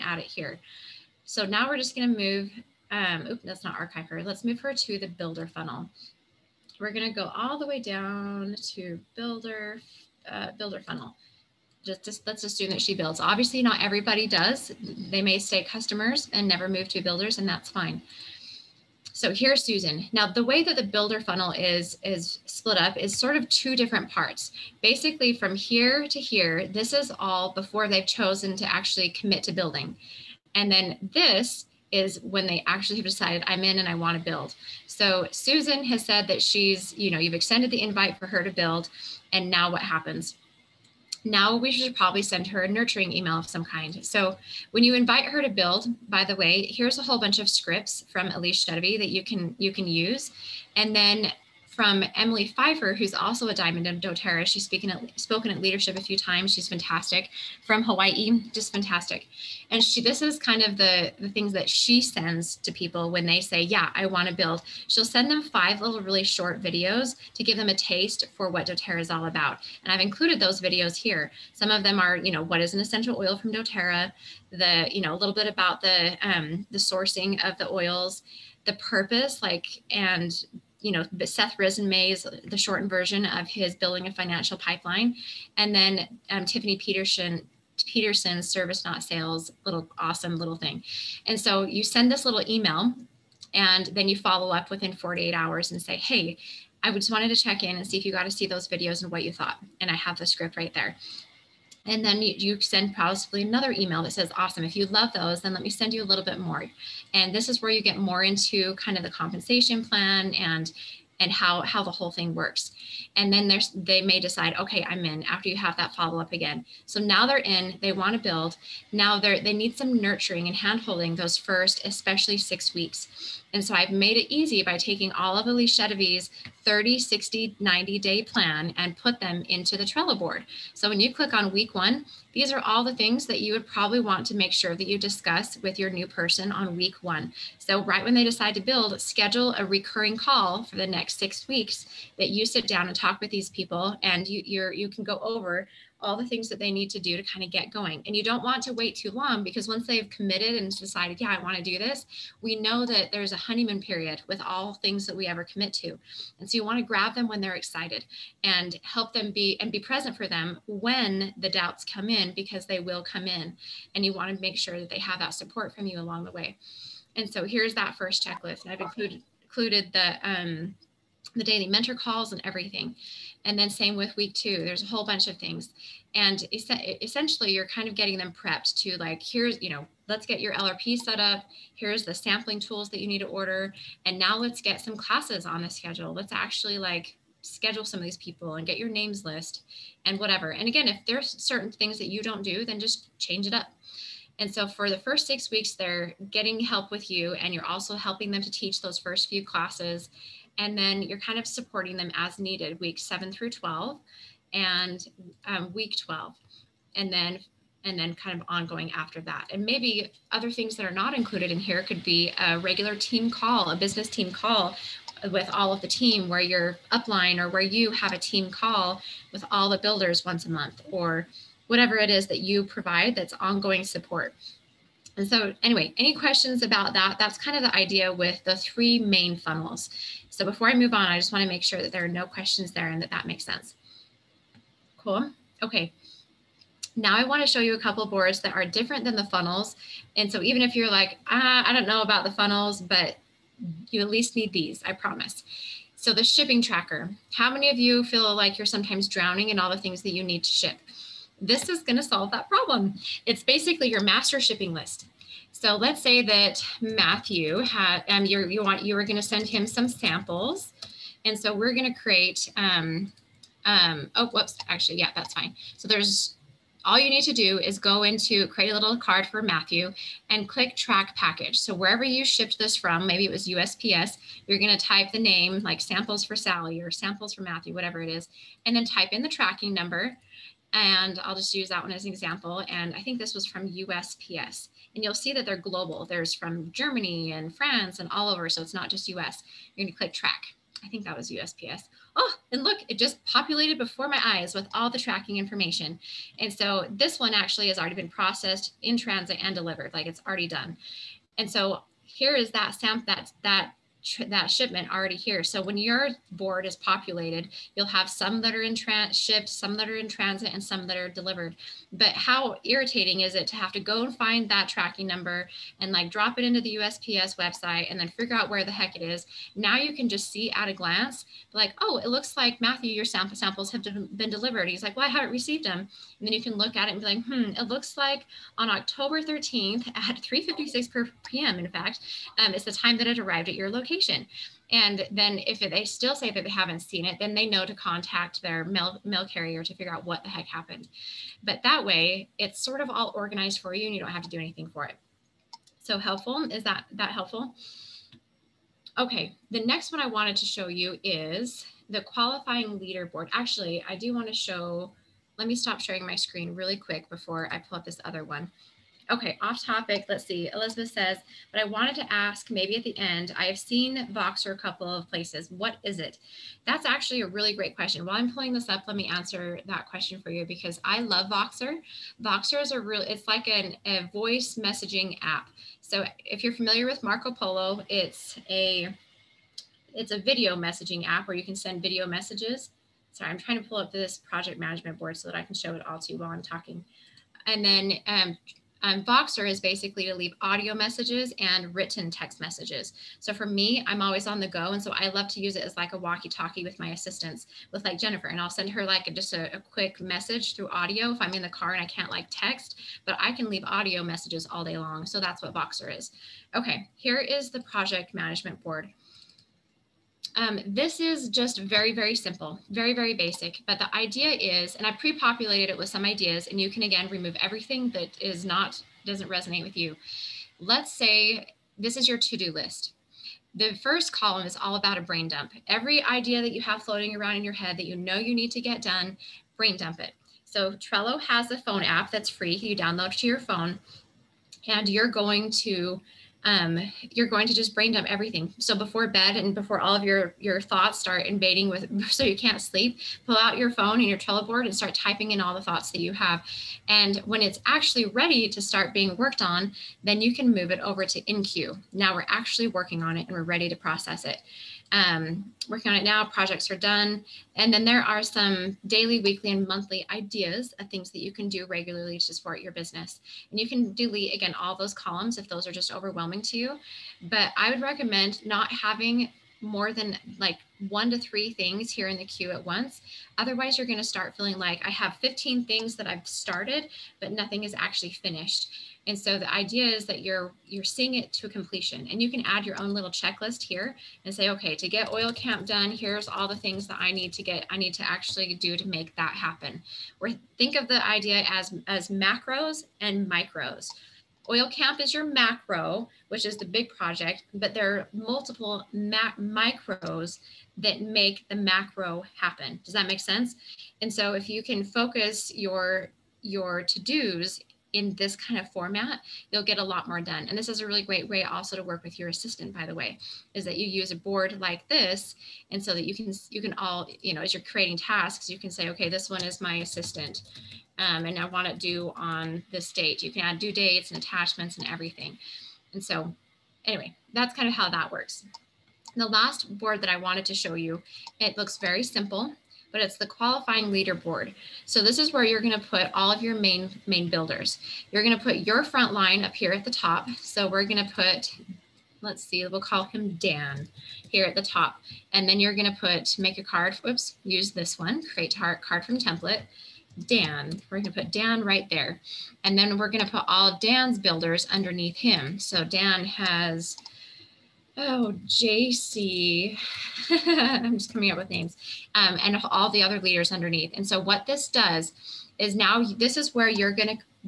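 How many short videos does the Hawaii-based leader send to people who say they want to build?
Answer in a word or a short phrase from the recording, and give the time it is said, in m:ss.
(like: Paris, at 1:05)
5, at 1:05.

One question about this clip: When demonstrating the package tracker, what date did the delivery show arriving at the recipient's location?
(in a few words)
October 13th.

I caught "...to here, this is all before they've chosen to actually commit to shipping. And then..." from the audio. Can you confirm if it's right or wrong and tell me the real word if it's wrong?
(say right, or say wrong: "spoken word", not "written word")
wrong: "building", not "shipping".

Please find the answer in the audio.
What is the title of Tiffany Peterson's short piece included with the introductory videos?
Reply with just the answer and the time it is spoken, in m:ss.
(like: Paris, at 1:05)
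Service Not Sales, at 1:28.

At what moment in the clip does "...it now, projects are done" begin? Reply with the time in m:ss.
7:35.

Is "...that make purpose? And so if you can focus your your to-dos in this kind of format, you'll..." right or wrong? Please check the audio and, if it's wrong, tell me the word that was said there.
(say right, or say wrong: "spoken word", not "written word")
wrong: "sense", not "purpose".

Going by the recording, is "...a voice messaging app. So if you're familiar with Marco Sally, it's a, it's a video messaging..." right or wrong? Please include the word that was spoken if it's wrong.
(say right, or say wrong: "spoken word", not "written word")
wrong: "Polo", not "Sally".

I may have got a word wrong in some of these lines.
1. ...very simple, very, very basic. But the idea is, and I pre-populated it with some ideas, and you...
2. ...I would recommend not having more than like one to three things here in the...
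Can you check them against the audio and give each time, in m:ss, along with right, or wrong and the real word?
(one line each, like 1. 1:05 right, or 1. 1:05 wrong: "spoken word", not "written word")
1. 6:51 right
2. 7:47 right.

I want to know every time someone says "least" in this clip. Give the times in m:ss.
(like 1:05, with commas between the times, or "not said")
4:04.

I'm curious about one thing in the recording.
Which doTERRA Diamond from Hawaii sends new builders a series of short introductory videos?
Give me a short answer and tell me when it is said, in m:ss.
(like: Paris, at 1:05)
Emily Pfeiffer, at 0:52.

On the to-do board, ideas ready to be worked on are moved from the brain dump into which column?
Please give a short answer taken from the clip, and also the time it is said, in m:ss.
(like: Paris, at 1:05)
InQ, at 7:31.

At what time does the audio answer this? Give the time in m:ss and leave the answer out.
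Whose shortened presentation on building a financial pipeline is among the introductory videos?
1:21.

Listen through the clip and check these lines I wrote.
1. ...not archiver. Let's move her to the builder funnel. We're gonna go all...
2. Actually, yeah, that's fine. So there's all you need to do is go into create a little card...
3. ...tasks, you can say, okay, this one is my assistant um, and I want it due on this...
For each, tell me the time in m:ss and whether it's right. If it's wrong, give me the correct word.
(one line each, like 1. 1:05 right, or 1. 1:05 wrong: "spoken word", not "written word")
1. 0:03 right
2. 4:24 right
3. 8:37 right.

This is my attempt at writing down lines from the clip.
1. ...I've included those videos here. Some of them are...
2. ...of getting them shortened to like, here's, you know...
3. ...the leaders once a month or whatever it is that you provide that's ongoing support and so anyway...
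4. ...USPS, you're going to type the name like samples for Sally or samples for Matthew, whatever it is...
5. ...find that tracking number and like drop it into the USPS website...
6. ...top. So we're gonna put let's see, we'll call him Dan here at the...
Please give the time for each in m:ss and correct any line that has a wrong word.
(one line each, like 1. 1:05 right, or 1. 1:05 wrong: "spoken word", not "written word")
1. 1:09 right
2. 2:57 wrong: "prepped", not "shortened"
3. 3:39 wrong: "builders", not "leaders"
4. 4:33 right
5. 5:14 right
6. 8:59 right.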